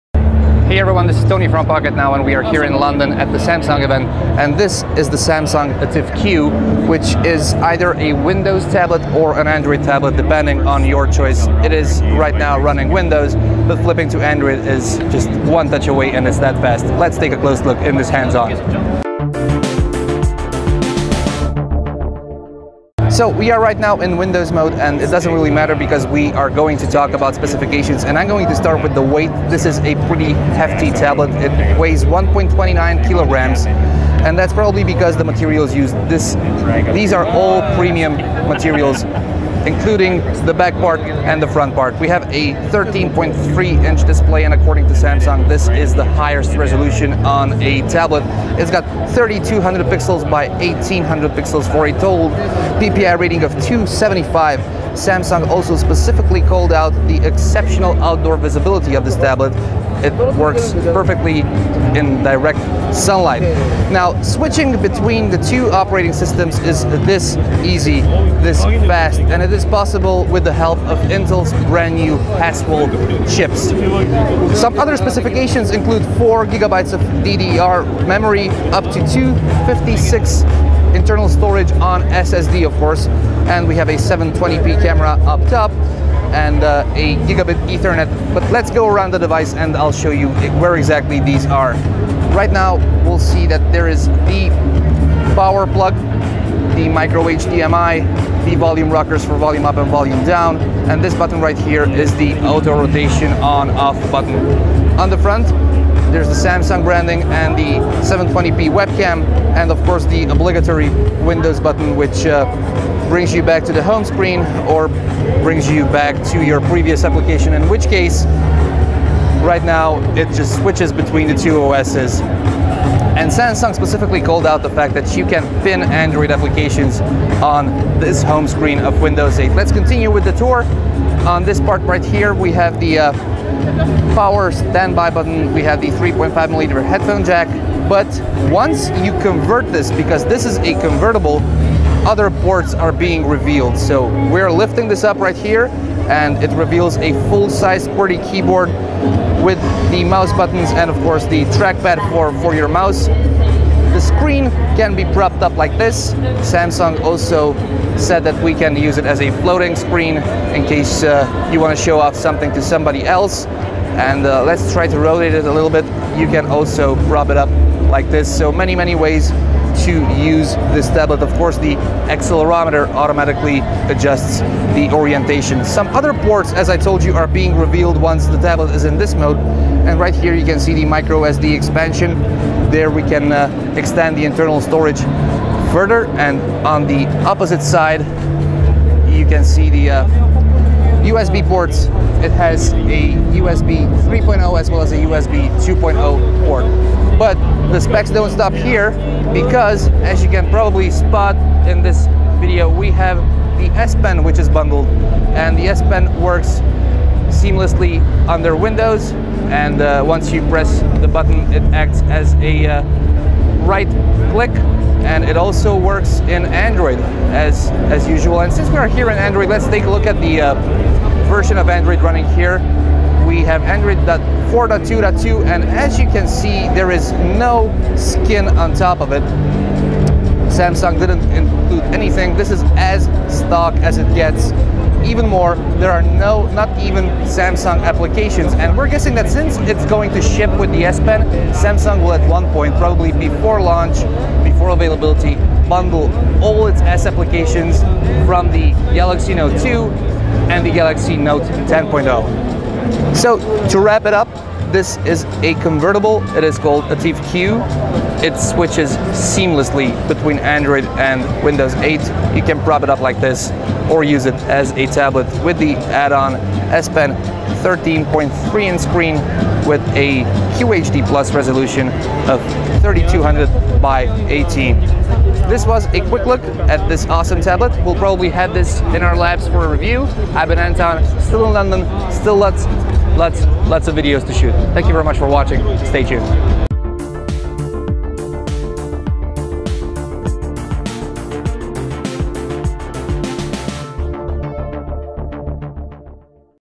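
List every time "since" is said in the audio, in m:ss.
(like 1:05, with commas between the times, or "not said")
3:38, 3:59.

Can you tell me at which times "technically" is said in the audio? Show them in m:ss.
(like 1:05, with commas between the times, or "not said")
not said.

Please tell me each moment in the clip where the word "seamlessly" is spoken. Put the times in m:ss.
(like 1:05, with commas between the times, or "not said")
3:27, 4:19.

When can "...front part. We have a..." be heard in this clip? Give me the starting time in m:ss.
0:41.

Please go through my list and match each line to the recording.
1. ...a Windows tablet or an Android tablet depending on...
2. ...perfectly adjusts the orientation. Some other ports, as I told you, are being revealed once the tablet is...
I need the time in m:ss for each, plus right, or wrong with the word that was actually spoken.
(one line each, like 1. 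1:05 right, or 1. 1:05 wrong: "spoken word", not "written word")
1. 0:07 right
2. 2:52 wrong: "automatically", not "perfectly".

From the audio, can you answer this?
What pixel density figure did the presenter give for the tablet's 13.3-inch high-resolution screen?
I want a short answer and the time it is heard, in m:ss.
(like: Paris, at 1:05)
275, at 0:53.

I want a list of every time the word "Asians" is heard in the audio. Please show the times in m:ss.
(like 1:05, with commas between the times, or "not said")
not said.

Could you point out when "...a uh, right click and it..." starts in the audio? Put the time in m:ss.
3:32.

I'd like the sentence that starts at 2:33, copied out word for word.
The screen can be propped up like this.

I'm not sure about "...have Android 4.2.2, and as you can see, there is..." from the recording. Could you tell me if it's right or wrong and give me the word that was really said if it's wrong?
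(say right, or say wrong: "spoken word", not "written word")
right.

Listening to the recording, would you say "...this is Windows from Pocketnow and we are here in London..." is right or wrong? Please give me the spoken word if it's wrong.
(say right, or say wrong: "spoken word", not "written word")
wrong: "Tony", not "Windows".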